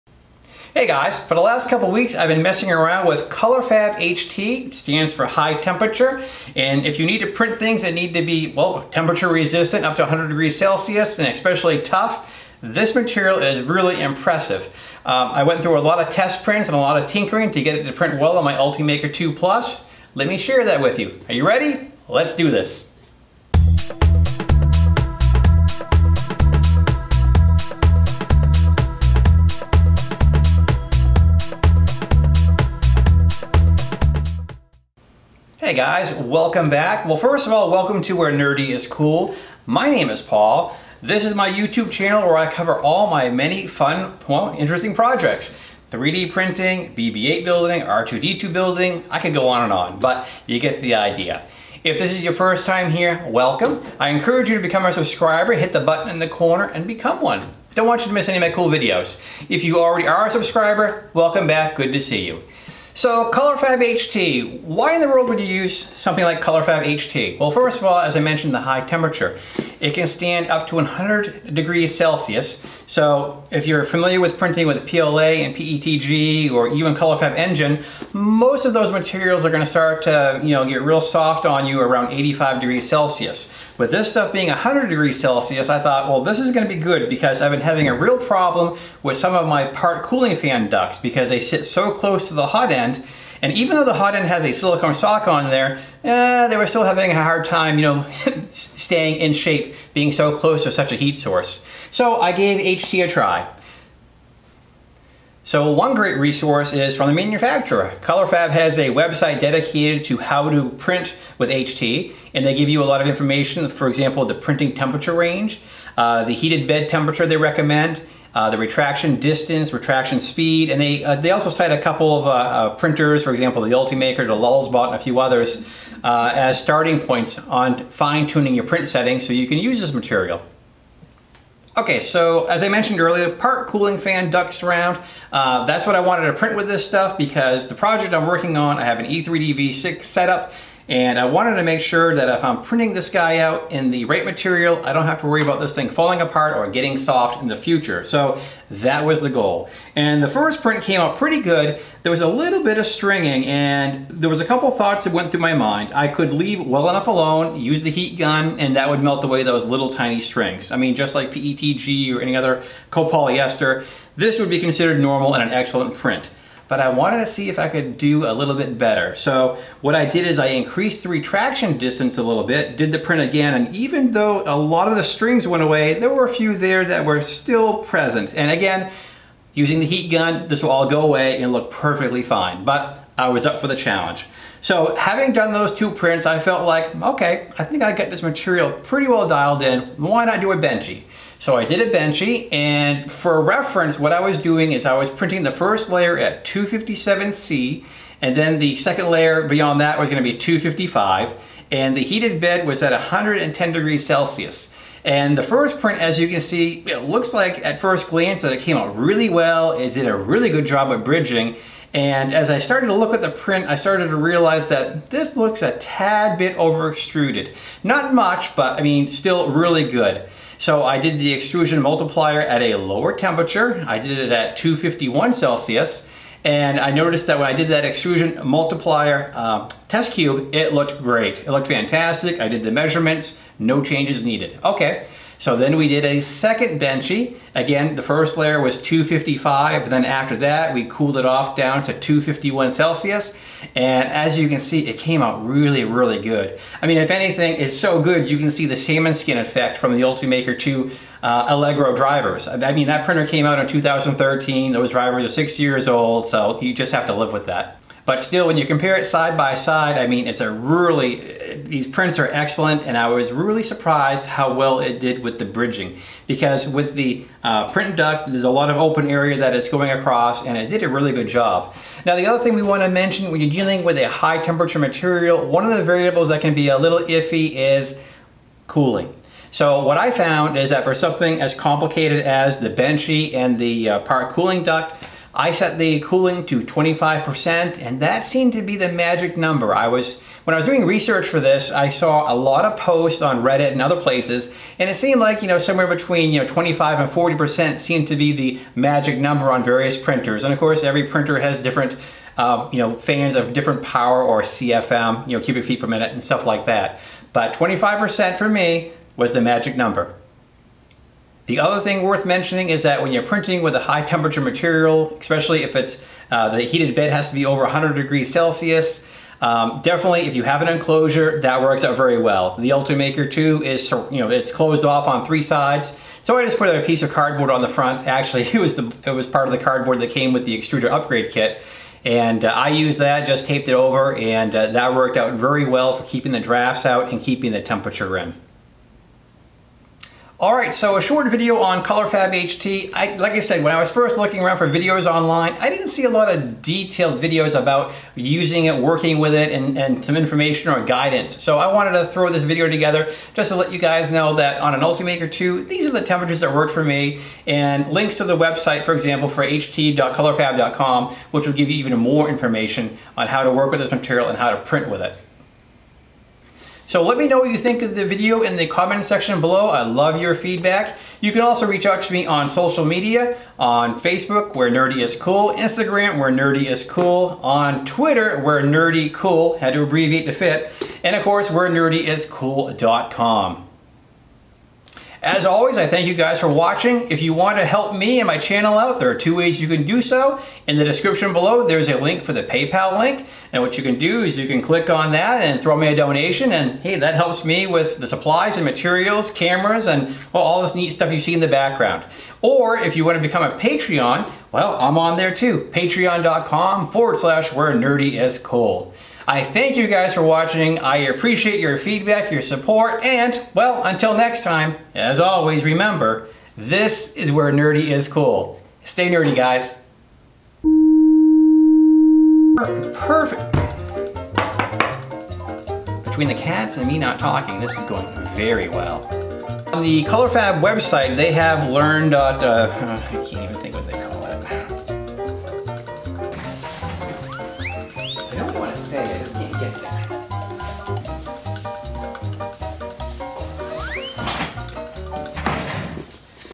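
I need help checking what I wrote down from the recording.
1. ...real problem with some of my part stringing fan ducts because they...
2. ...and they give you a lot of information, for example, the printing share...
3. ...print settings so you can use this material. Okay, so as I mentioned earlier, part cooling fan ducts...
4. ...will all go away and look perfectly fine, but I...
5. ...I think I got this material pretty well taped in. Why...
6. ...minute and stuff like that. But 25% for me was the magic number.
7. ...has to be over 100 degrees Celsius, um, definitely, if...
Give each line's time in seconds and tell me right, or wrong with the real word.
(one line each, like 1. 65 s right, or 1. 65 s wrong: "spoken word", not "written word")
1. 87 s wrong: "cooling", not "stringing"
2. 112 s wrong: "temperature", not "share"
3. 128 s right
4. 180 s right
5. 187 s wrong: "dialed", not "taped"
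6. 305 s right
7. 317 s right.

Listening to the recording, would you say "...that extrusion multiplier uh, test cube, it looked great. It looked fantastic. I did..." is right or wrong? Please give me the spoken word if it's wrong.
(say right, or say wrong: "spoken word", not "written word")
right.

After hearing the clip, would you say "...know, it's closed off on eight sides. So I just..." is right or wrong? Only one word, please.
wrong.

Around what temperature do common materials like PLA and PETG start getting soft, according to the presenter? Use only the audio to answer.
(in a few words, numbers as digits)
85 degrees Celsius.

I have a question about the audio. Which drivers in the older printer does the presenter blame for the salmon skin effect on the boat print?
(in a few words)
Allegro drivers.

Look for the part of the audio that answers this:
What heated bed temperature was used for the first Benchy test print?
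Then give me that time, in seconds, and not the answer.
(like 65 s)
202 s.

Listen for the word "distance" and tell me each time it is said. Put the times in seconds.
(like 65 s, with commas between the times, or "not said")
119 s, 171 s.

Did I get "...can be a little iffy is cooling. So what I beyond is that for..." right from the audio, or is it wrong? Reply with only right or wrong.
wrong.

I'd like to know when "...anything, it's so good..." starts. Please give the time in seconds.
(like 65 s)
247 s.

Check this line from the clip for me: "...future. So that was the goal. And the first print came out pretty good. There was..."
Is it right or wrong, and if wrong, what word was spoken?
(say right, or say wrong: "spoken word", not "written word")
right.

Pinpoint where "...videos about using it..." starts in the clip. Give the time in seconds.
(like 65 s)
347 s.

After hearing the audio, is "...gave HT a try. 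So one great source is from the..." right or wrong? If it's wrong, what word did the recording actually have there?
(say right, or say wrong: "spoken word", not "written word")
wrong: "resource", not "source".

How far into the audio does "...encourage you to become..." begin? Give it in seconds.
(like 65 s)
54 s.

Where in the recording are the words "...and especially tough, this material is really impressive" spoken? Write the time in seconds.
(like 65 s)
11 s.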